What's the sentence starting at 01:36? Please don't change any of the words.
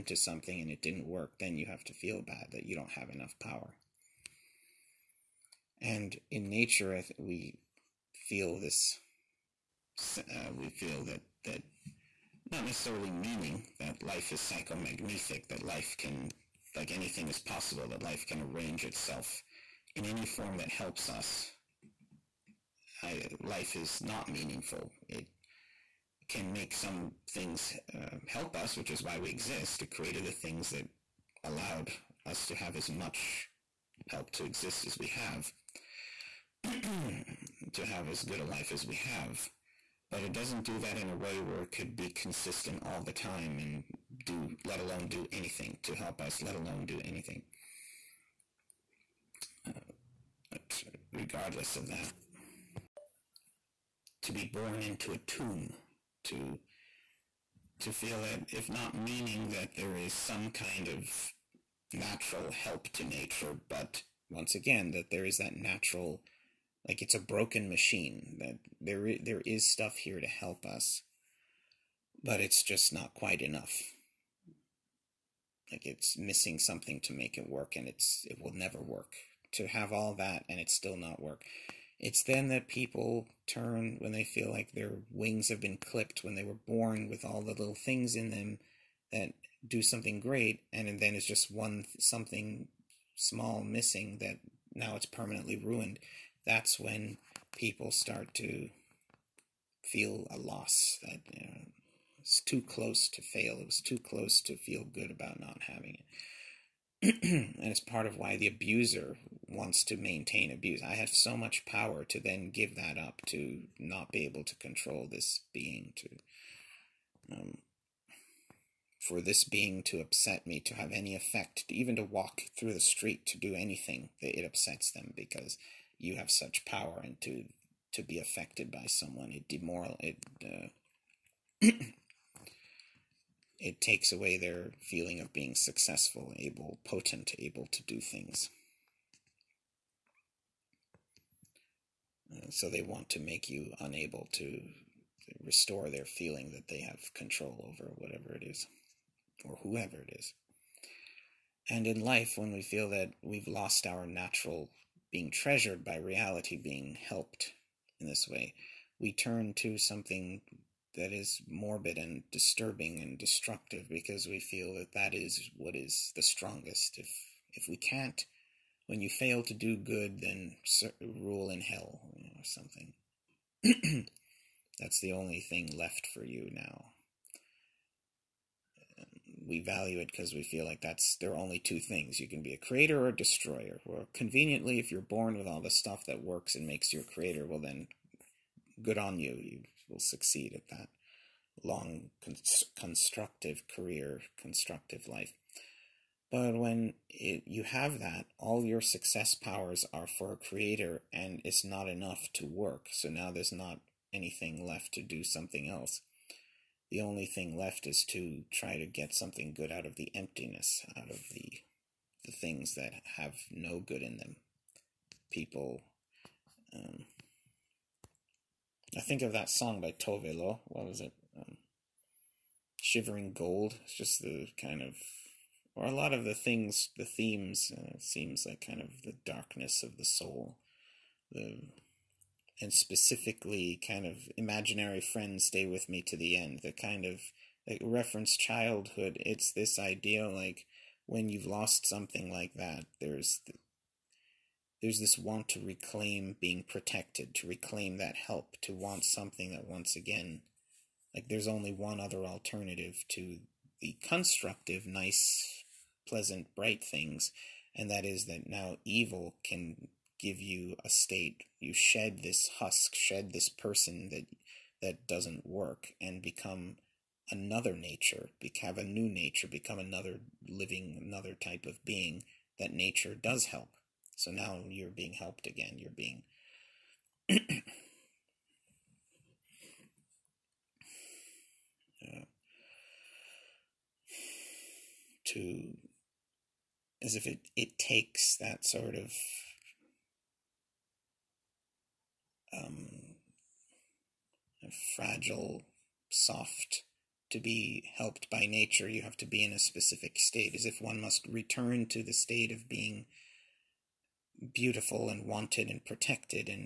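That's when people start to feel a loss that you know, it's too close to fail.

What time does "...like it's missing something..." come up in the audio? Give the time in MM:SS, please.
01:15.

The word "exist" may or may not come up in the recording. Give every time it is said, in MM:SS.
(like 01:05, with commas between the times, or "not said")
00:29, 00:34.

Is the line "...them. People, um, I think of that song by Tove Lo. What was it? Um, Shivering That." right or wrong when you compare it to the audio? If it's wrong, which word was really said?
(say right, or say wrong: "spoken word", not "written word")
wrong: "Gold", not "That".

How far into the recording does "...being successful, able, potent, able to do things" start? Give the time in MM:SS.
02:15.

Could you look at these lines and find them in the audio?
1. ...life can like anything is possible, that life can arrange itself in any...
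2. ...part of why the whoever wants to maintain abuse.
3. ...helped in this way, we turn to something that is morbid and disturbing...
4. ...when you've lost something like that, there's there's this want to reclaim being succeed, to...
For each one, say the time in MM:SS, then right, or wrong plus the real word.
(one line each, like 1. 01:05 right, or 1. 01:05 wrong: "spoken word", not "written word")
1. 00:15 right
2. 01:47 wrong: "abuser", not "whoever"
3. 02:37 right
4. 04:01 wrong: "protected", not "succeed".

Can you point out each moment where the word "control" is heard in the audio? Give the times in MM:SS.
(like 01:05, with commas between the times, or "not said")
01:54, 02:27.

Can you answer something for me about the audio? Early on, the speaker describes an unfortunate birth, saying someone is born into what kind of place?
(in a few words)
a tomb.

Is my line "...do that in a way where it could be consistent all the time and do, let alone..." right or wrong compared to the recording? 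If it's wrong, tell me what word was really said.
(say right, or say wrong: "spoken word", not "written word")
right.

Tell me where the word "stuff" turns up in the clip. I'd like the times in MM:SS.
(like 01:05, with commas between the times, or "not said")
01:09, 03:05.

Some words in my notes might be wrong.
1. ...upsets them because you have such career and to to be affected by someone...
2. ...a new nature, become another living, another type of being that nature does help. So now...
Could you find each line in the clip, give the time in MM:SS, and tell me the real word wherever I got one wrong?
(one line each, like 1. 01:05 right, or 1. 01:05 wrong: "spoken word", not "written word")
1. 02:04 wrong: "power", not "career"
2. 04:28 right.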